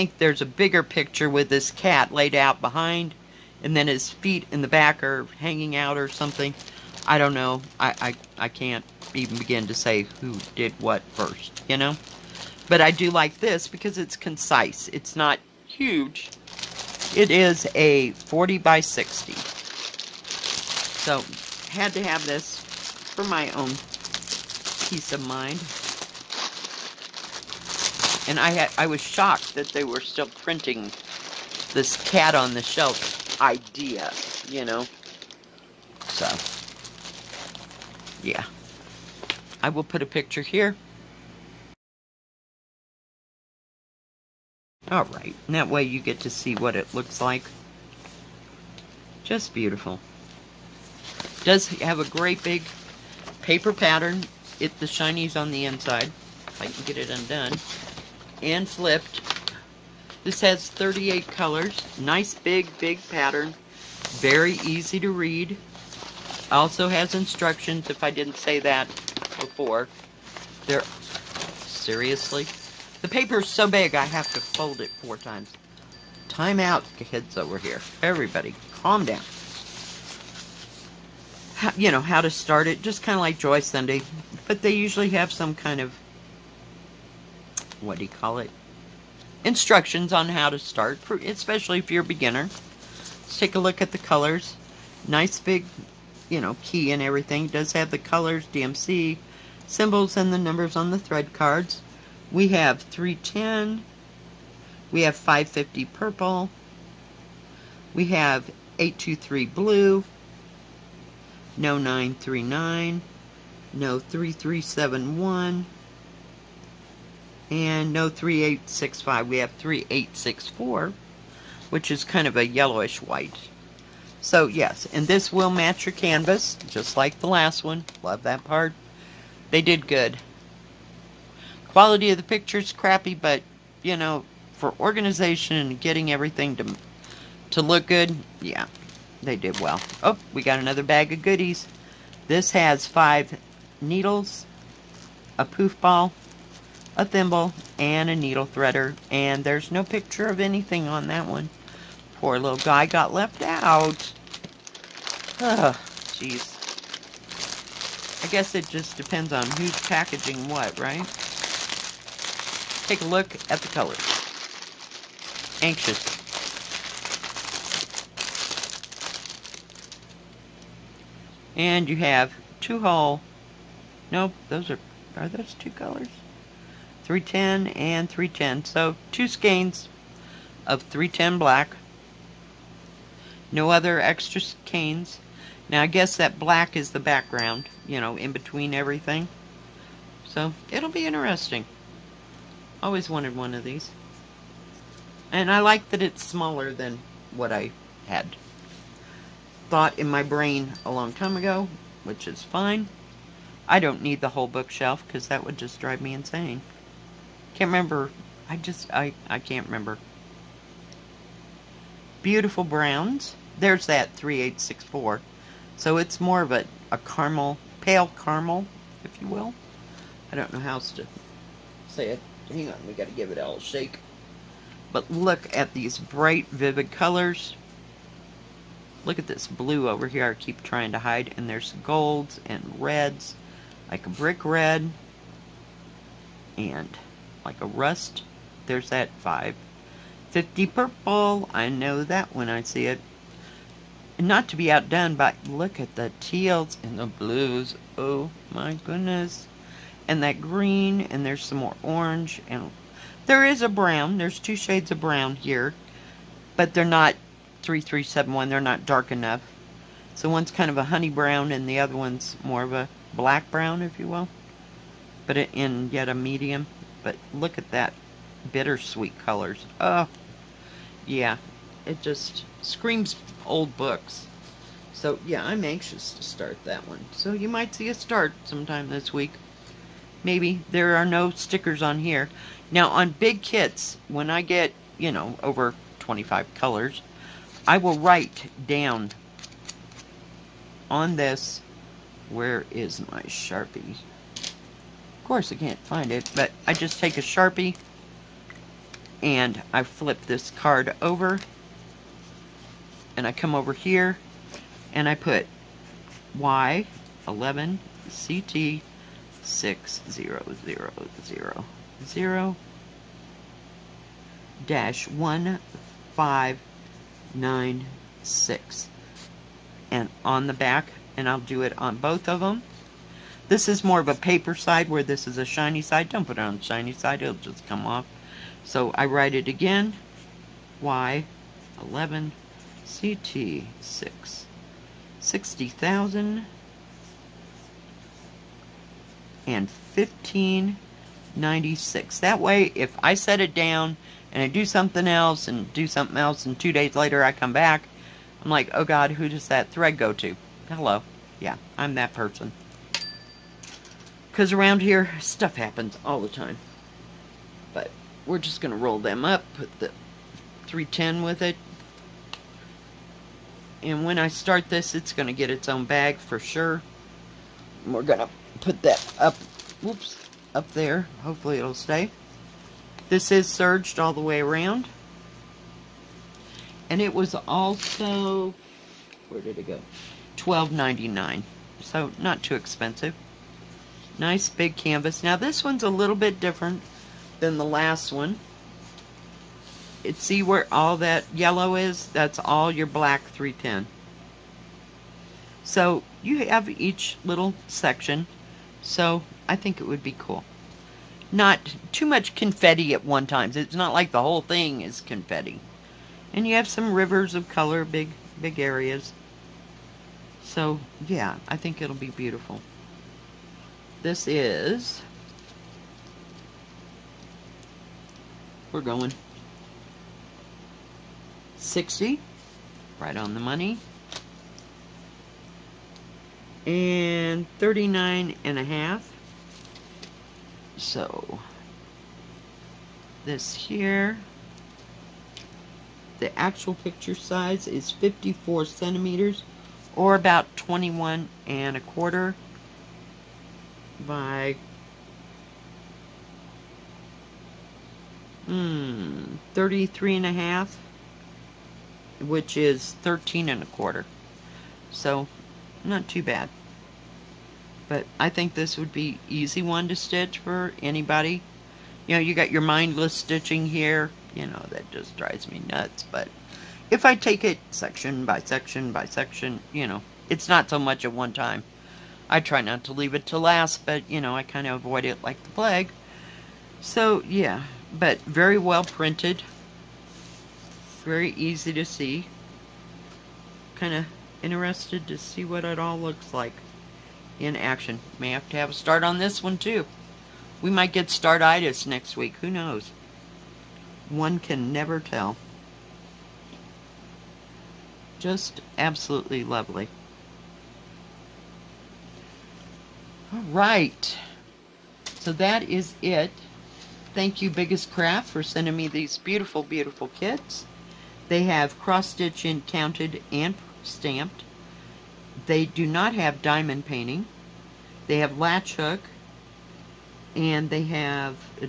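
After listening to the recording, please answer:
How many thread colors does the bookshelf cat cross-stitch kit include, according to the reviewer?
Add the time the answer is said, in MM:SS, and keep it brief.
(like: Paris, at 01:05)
38, at 01:00.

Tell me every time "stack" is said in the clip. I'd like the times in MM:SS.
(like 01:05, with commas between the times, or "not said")
not said.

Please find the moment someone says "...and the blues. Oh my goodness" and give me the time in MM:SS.
04:06.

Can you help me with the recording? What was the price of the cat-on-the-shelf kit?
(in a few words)
$12.99.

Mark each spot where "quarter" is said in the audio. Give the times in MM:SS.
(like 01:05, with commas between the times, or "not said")
07:21, 07:33.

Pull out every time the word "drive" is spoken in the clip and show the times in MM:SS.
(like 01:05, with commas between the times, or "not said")
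03:25, 07:45.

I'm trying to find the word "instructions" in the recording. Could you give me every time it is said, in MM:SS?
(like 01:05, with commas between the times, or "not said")
01:07, 01:29.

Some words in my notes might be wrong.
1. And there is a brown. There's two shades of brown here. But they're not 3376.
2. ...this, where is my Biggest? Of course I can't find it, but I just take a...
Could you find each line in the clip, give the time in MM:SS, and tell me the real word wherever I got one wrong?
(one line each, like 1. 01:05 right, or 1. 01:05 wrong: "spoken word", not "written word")
1. 04:12 wrong: "3371", not "3376"
2. 04:51 wrong: "Sharpie", not "Biggest".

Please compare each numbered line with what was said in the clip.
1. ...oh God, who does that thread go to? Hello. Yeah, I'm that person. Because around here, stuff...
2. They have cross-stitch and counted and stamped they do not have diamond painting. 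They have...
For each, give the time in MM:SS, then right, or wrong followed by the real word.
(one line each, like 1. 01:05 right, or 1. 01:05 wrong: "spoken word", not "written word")
1. 05:48 right
2. 08:31 right.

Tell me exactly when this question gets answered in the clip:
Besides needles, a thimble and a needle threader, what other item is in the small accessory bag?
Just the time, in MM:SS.
02:25.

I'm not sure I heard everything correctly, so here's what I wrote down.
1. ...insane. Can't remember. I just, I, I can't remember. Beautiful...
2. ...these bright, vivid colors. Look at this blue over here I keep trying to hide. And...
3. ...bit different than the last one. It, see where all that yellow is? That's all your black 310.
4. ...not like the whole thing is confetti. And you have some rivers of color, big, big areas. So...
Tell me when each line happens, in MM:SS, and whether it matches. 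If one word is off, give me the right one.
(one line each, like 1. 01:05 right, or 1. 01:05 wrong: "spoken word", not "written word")
1. 03:26 right
2. 03:45 right
3. 06:26 right
4. 06:43 right.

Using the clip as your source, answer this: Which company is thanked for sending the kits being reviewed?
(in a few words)
Biggest Craft.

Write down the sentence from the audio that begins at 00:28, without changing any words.
And I had I was shocked that they were still printing this cat on the shelf idea, you know.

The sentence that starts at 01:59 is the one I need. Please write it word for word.
We have 3864, which is kind of a yellowish white.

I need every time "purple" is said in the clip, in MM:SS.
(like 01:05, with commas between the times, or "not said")
01:45, 04:00.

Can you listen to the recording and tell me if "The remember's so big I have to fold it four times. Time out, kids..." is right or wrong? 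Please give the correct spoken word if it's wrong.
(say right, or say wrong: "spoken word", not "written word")
wrong: "paper", not "remember".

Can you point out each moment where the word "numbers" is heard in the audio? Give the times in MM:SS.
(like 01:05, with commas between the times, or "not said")
01:40.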